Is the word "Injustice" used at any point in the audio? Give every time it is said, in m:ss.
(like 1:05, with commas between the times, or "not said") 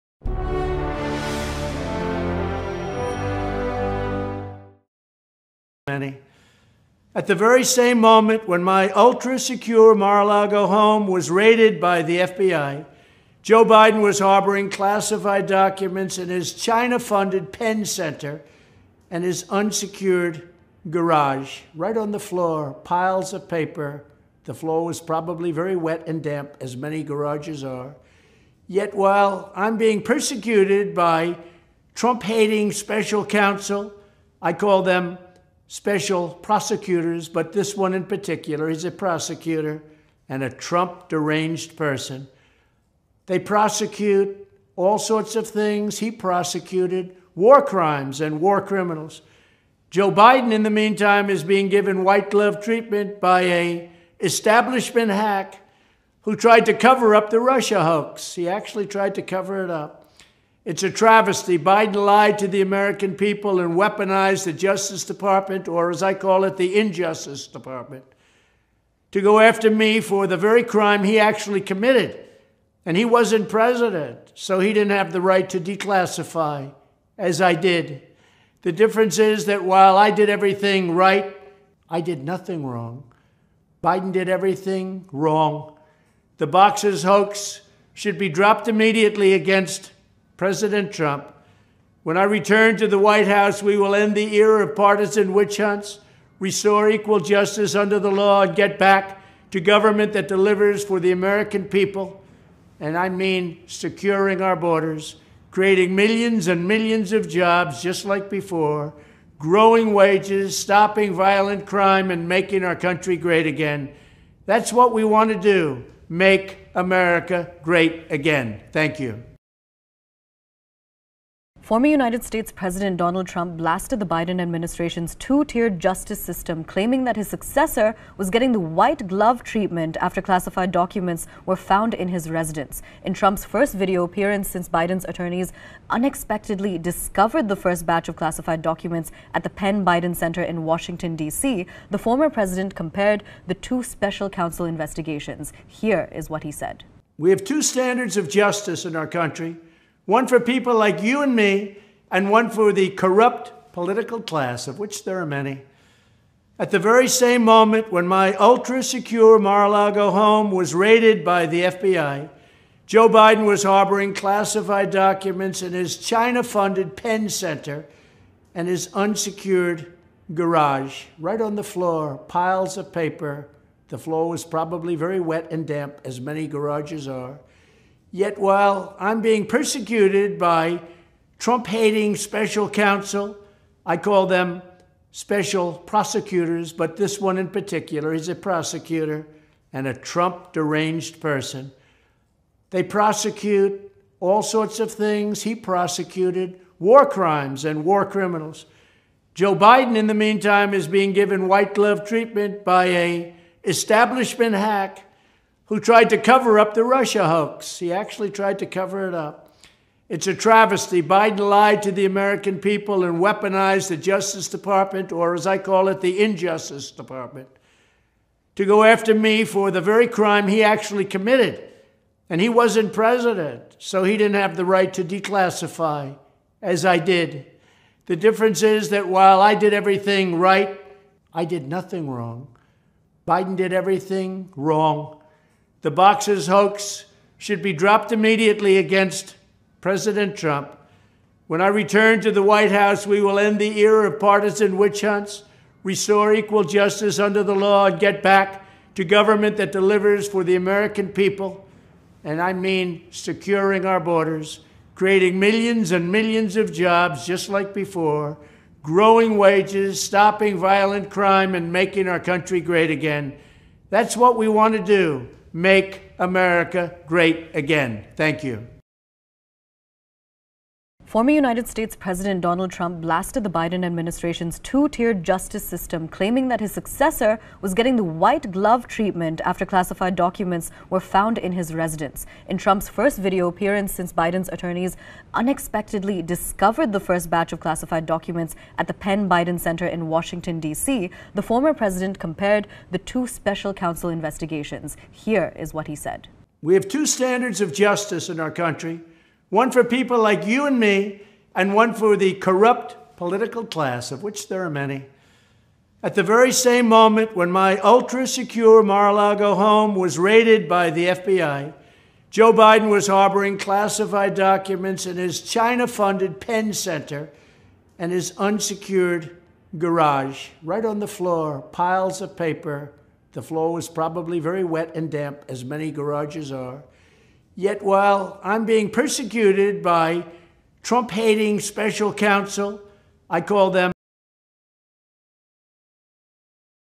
1:06, 3:36.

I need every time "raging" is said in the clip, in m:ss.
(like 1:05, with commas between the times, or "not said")
not said.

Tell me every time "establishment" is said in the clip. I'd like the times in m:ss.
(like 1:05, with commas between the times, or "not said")
0:54, 3:23.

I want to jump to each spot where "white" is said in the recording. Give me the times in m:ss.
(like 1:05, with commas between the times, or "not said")
0:52, 1:32, 2:08, 3:21, 4:02, 4:38.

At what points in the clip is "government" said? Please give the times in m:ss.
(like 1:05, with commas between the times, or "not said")
1:39, 4:09.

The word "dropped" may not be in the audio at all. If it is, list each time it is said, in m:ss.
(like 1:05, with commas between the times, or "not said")
1:28, 3:57.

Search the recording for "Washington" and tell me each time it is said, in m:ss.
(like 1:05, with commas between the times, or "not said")
2:20, 4:50.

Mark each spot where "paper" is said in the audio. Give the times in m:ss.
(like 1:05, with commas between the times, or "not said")
0:23, 2:52, 5:22.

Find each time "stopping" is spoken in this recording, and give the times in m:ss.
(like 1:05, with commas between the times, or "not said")
1:50, 4:20.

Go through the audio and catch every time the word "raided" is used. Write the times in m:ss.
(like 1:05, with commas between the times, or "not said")
0:11, 2:40, 5:10.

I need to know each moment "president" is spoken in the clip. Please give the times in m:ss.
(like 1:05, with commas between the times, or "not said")
1:13, 1:30, 2:02, 2:22, 3:42, 3:59, 4:31, 4:51.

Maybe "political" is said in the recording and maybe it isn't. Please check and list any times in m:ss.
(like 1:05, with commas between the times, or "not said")
2:33, 5:03.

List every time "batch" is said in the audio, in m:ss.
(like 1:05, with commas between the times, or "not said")
2:17, 4:47.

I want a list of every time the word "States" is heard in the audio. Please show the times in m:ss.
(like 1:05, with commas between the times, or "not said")
2:02, 4:31.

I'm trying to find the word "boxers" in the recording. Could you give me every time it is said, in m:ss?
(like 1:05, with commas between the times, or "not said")
1:26, 3:55.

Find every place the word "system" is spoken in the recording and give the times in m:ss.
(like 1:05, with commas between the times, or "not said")
2:06, 4:35.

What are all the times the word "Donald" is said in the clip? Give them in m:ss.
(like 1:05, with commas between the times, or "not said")
2:02, 4:32.